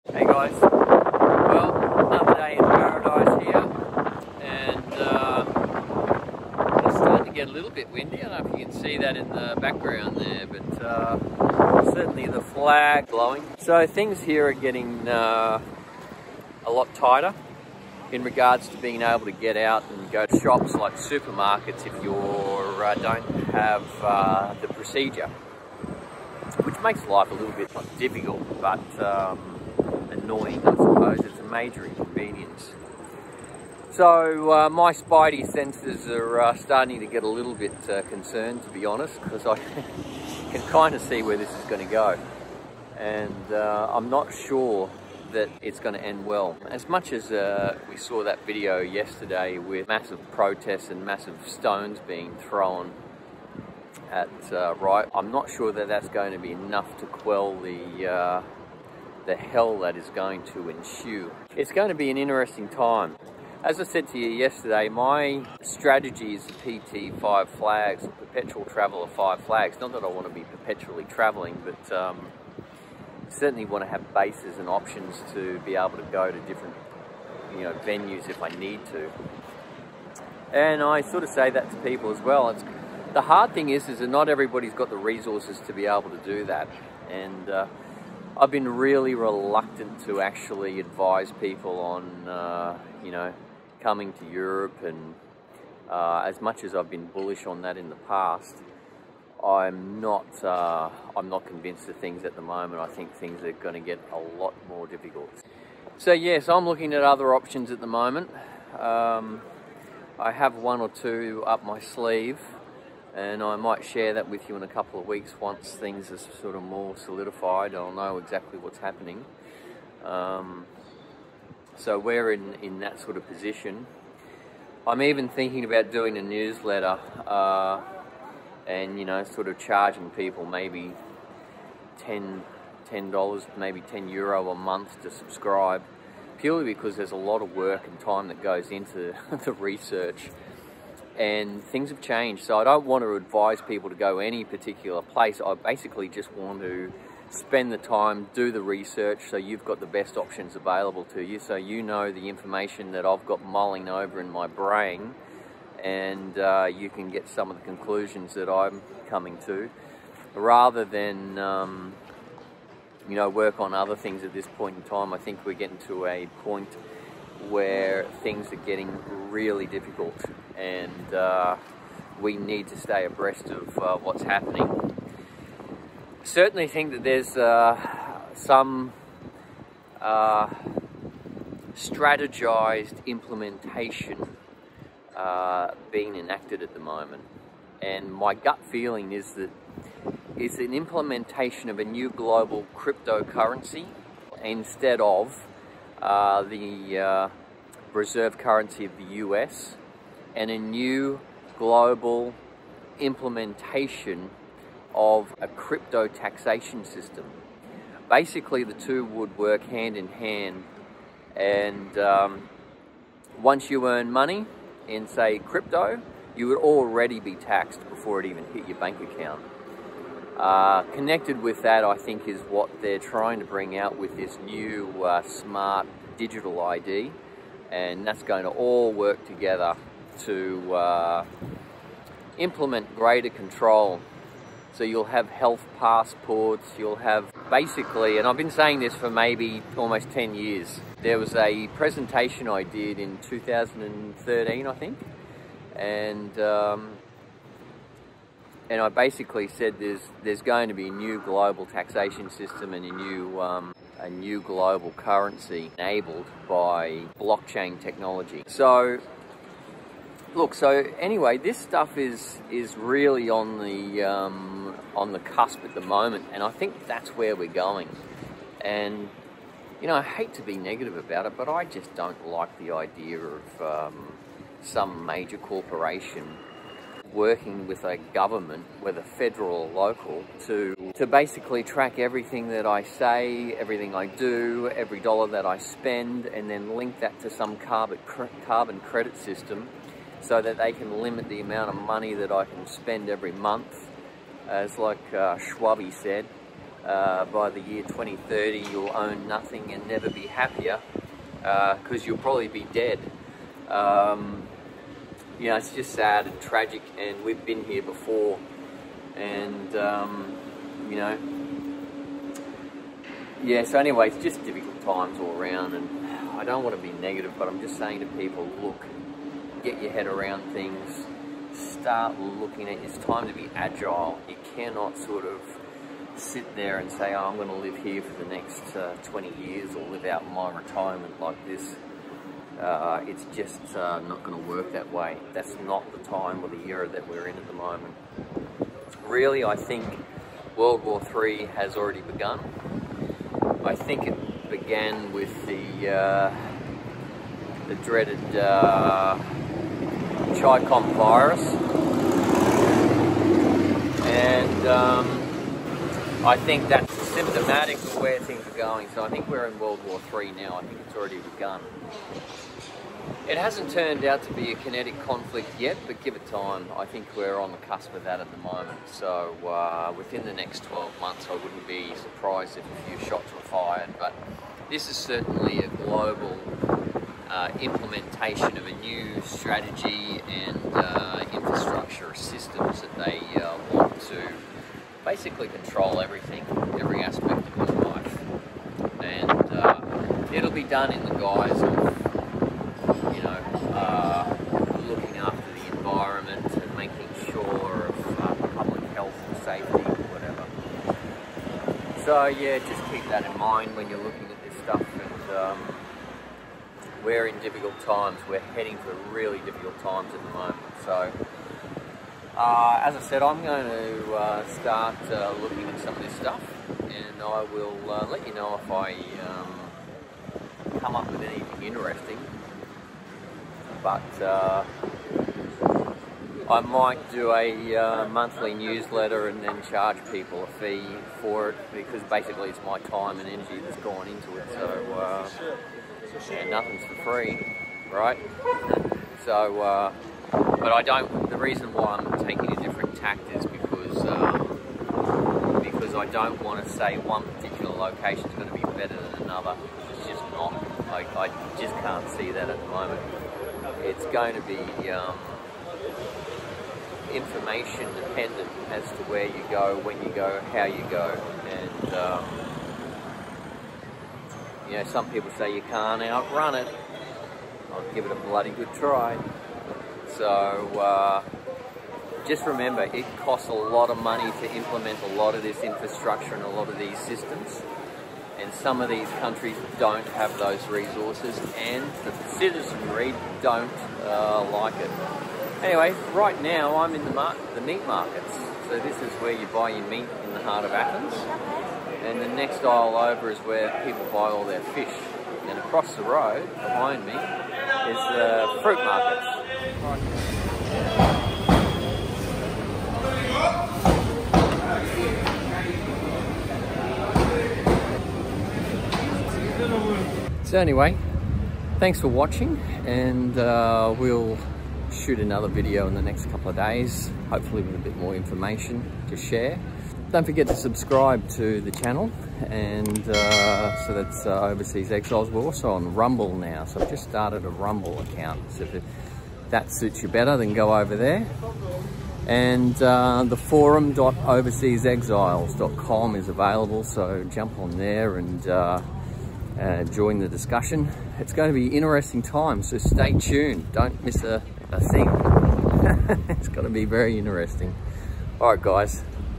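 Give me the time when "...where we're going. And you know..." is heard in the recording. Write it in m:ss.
4:27.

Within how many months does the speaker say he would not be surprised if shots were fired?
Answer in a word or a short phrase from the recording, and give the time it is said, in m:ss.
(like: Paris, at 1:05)
12, at 6:10.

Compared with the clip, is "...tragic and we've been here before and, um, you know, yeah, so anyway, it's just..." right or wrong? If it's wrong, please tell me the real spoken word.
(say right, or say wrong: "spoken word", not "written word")
right.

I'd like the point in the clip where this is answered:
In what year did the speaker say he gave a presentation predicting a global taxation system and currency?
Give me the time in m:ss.
4:03.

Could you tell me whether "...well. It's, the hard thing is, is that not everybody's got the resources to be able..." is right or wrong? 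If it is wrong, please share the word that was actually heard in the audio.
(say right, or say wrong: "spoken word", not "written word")
right.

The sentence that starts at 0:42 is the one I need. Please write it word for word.
And uh, I'm not sure that it's going to end well.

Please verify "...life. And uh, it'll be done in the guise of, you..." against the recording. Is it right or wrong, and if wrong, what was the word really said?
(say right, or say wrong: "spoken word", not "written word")
right.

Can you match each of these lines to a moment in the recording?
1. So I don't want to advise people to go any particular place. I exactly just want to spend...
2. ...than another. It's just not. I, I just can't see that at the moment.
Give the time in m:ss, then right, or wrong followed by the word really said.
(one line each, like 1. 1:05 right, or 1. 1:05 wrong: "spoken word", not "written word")
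1. 2:22 wrong: "basically", not "exactly"
2. 7:28 right.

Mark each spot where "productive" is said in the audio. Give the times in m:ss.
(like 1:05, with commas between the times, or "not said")
not said.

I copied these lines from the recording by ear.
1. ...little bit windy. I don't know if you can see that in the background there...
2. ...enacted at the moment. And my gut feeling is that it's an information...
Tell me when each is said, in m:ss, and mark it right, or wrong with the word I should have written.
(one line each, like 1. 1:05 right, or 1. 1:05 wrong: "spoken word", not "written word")
1. 0:07 right
2. 3:06 wrong: "implementation", not "information".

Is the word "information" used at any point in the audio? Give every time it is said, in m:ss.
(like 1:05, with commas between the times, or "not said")
2:32, 7:37, 8:38.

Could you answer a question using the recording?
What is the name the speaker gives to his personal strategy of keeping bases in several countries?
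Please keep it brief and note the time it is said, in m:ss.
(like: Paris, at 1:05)
PT Five Flags, at 1:06.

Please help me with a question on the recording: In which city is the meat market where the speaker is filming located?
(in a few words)
Athens.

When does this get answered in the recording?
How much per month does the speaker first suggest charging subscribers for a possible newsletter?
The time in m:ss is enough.
2:11.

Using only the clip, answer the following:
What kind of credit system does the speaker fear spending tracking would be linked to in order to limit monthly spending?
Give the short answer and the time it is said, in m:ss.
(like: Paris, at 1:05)
carbon credit system, at 4:47.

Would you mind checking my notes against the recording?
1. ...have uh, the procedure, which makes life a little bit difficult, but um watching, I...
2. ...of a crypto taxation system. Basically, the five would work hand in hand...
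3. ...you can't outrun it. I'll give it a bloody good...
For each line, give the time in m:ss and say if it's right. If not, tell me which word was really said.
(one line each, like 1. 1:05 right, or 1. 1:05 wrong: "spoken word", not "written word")
1. 0:23 wrong: "annoying", not "watching"
2. 3:24 wrong: "two", not "five"
3. 7:45 right.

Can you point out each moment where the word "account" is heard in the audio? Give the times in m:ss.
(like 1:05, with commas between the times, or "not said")
3:38, 8:47.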